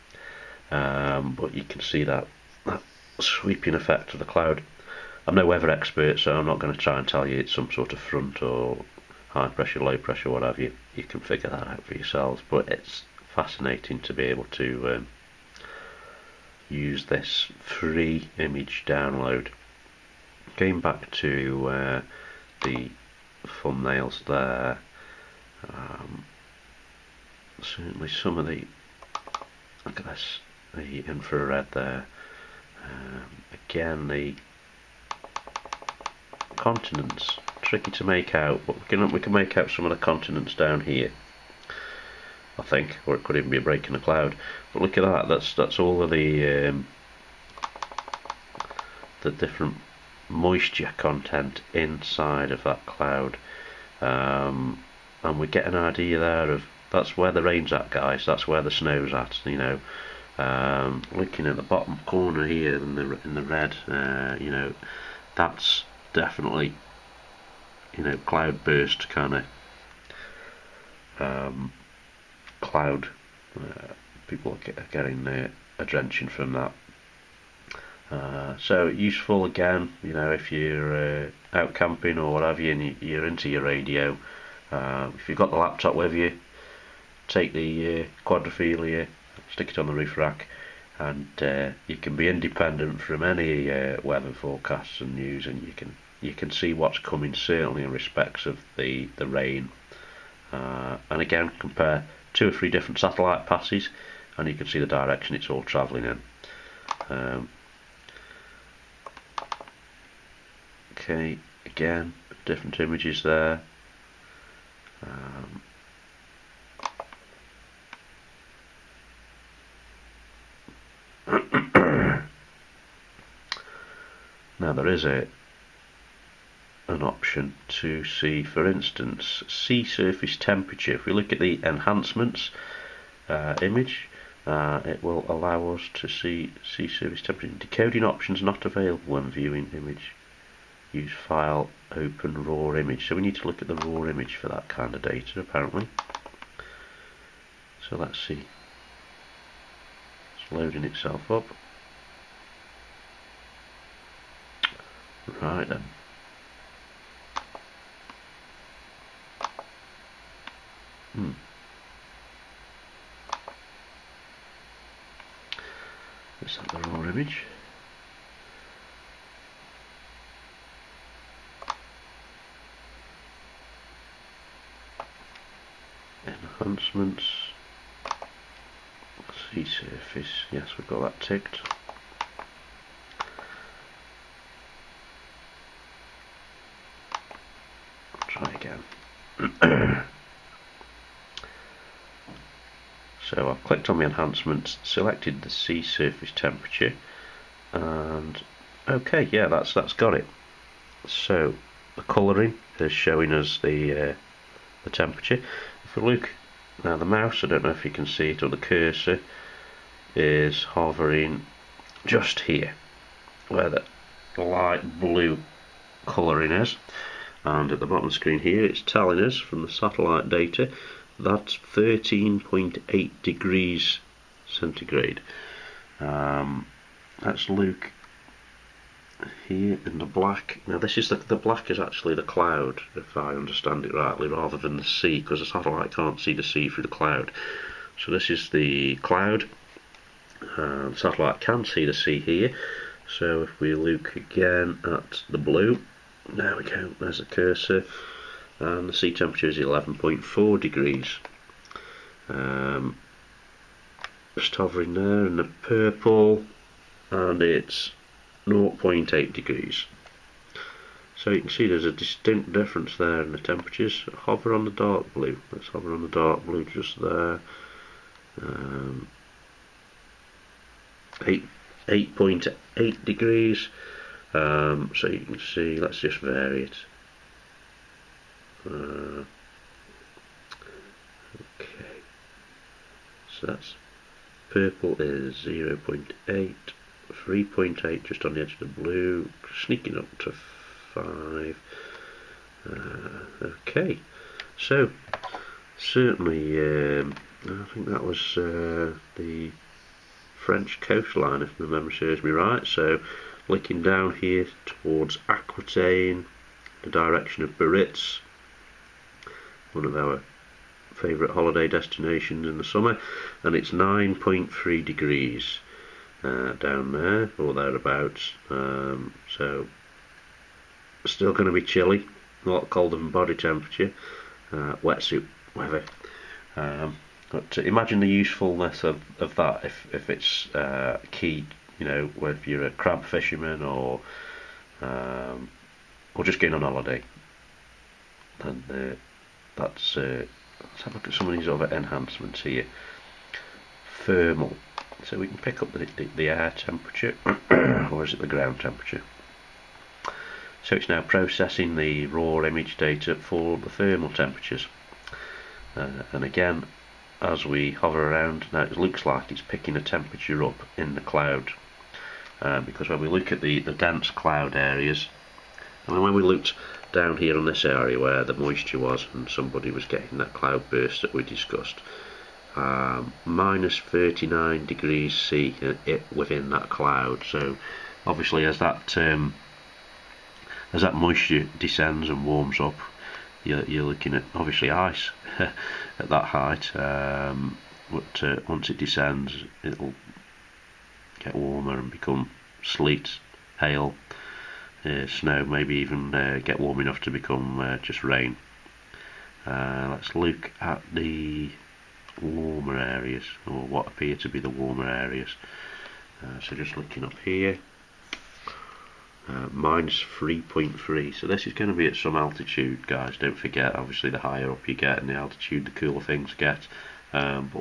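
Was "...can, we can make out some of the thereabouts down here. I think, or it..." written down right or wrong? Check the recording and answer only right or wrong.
wrong.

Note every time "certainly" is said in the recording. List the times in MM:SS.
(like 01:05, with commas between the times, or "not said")
00:27, 01:37, 04:55.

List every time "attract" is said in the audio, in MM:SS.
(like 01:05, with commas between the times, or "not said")
not said.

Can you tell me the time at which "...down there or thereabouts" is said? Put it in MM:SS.
05:16.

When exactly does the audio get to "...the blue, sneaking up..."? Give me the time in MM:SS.
04:48.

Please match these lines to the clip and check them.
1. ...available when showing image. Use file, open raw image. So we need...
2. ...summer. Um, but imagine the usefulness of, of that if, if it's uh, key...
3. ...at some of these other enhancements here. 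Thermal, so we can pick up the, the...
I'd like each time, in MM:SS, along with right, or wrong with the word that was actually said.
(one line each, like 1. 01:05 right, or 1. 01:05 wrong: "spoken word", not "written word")
1. 02:18 wrong: "viewing", not "showing"
2. 05:25 wrong: "weather", not "summer"
3. 05:41 right.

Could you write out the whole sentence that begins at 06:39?
let's look at the warmer areas, or what appear to be the warmer areas.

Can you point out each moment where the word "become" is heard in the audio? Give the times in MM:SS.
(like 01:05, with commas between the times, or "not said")
06:31, 06:37.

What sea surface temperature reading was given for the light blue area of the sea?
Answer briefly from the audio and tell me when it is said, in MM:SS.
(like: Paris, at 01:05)
13.8 degrees, at 03:41.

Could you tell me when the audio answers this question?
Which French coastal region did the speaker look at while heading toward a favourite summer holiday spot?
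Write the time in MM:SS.
05:05.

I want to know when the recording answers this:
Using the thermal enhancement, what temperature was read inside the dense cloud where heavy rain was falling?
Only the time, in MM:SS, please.
06:13.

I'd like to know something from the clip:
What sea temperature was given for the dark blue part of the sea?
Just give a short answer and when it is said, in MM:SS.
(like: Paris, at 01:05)
8.8 degrees, at 04:31.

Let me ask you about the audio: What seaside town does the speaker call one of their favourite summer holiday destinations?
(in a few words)
Biarritz.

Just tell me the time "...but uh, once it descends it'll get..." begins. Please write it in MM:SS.
06:27.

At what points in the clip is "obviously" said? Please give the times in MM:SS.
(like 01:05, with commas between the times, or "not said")
06:18, 06:24, 06:53.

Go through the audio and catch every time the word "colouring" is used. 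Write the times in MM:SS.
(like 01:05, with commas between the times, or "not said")
03:22, 03:36.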